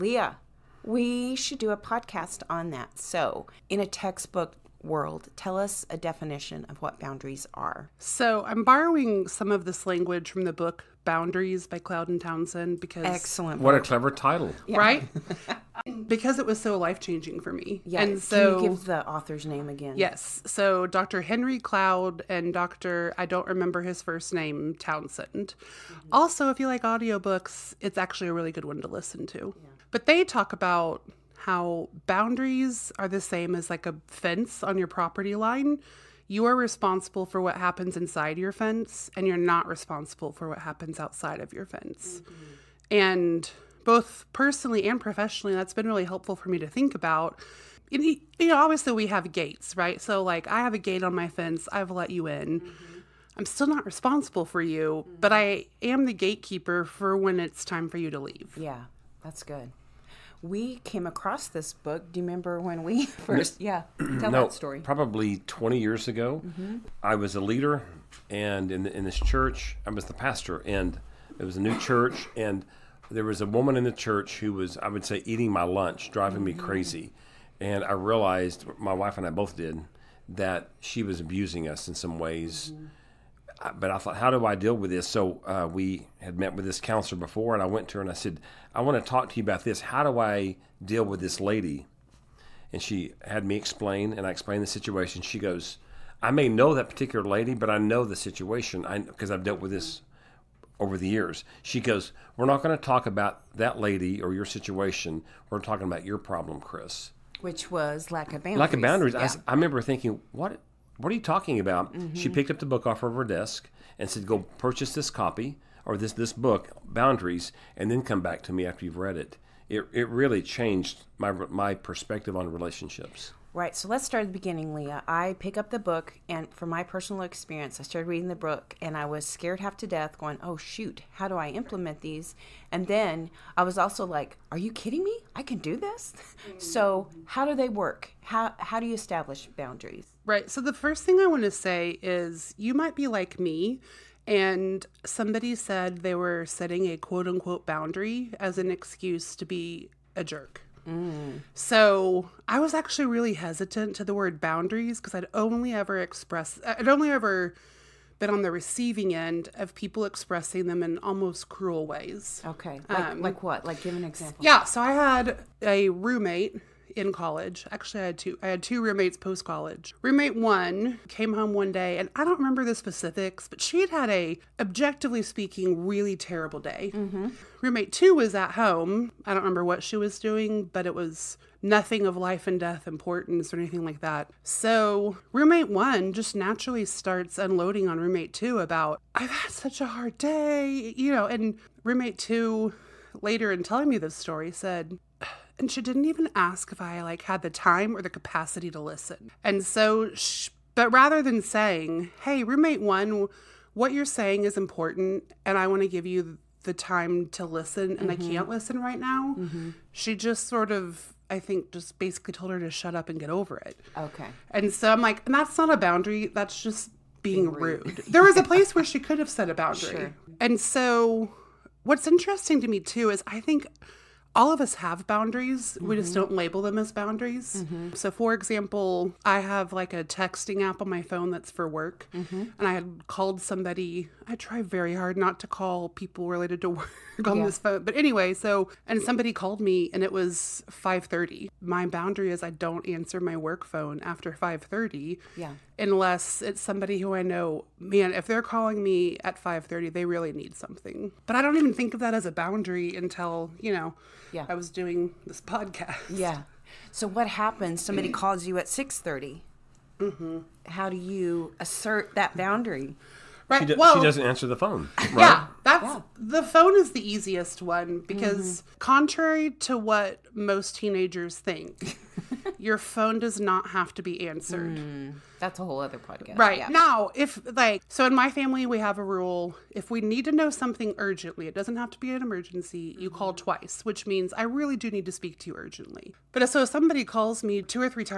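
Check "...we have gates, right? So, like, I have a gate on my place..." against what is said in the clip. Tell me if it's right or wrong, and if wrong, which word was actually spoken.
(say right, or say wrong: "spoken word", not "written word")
wrong: "fence", not "place".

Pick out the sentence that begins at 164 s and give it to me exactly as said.
So I had a roommate in college.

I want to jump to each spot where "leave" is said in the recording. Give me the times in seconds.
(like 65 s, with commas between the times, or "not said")
58 s.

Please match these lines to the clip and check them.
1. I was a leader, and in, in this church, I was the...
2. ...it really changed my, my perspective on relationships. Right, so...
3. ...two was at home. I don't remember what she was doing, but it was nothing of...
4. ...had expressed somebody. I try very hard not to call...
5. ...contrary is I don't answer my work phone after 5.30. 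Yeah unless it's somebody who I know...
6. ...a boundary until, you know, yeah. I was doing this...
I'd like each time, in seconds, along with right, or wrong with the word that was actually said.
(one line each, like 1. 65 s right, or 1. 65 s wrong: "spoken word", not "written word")
1. 67 s right
2. 119 s right
3. 177 s right
4. 232 s wrong: "called", not "expressed"
5. 241 s wrong: "boundary", not "contrary"
6. 252 s right.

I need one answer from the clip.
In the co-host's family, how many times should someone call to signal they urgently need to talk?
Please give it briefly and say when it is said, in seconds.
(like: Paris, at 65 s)
twice, at 283 s.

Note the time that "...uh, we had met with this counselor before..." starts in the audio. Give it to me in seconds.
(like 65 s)
85 s.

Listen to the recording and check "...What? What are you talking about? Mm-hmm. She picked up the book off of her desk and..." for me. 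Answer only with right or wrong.
right.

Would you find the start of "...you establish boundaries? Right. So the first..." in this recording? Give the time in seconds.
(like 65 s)
138 s.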